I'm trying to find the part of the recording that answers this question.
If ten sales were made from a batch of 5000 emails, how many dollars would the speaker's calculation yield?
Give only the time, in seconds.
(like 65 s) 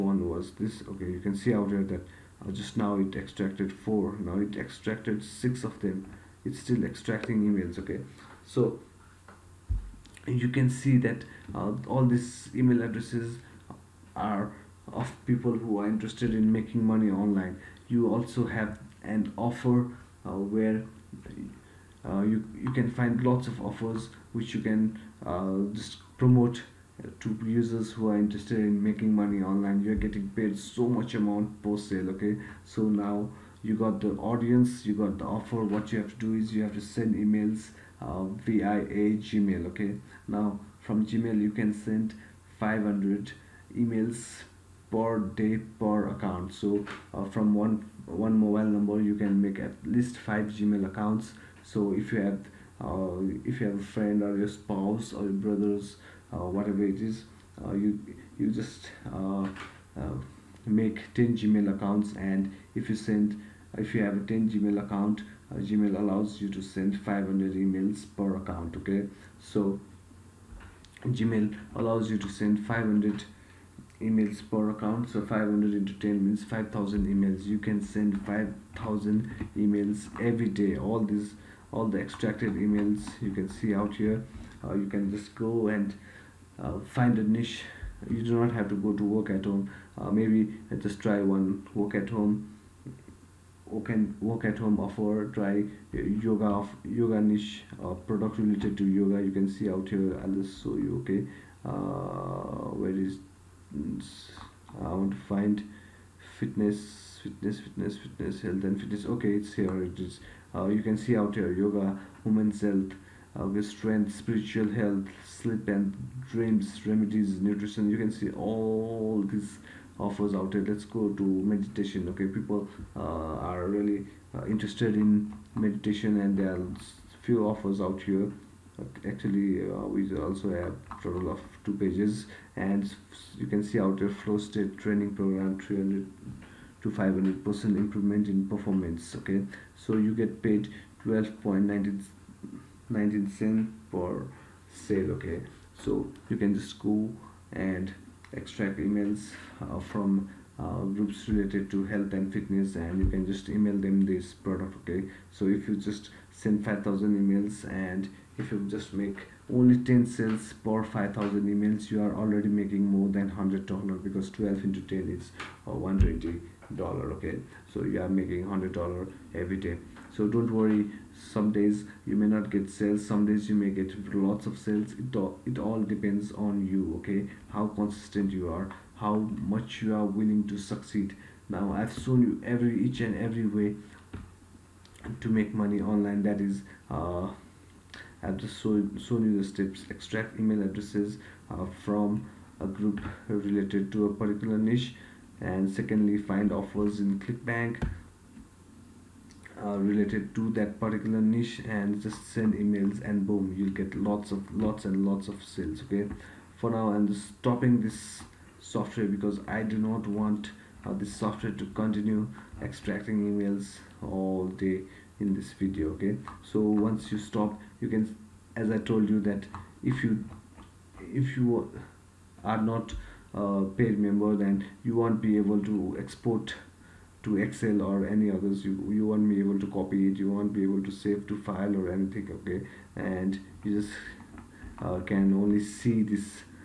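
165 s.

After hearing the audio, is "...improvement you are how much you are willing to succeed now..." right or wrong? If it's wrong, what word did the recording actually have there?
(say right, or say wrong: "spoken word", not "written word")
wrong: "consistent", not "improvement".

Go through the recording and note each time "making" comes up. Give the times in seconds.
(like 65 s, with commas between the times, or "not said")
16 s, 28 s, 162 s, 168 s.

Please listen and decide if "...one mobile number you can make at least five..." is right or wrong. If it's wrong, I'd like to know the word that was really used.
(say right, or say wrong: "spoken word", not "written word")
right.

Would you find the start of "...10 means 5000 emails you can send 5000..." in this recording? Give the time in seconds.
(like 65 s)
76 s.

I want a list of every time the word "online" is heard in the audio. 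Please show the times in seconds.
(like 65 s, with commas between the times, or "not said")
17 s, 29 s, 185 s.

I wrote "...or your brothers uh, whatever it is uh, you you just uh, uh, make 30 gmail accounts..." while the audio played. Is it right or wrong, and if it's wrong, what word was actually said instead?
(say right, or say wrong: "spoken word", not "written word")
wrong: "10", not "30".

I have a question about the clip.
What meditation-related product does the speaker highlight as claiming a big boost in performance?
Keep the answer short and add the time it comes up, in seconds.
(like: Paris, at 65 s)
Flow state training program, at 134 s.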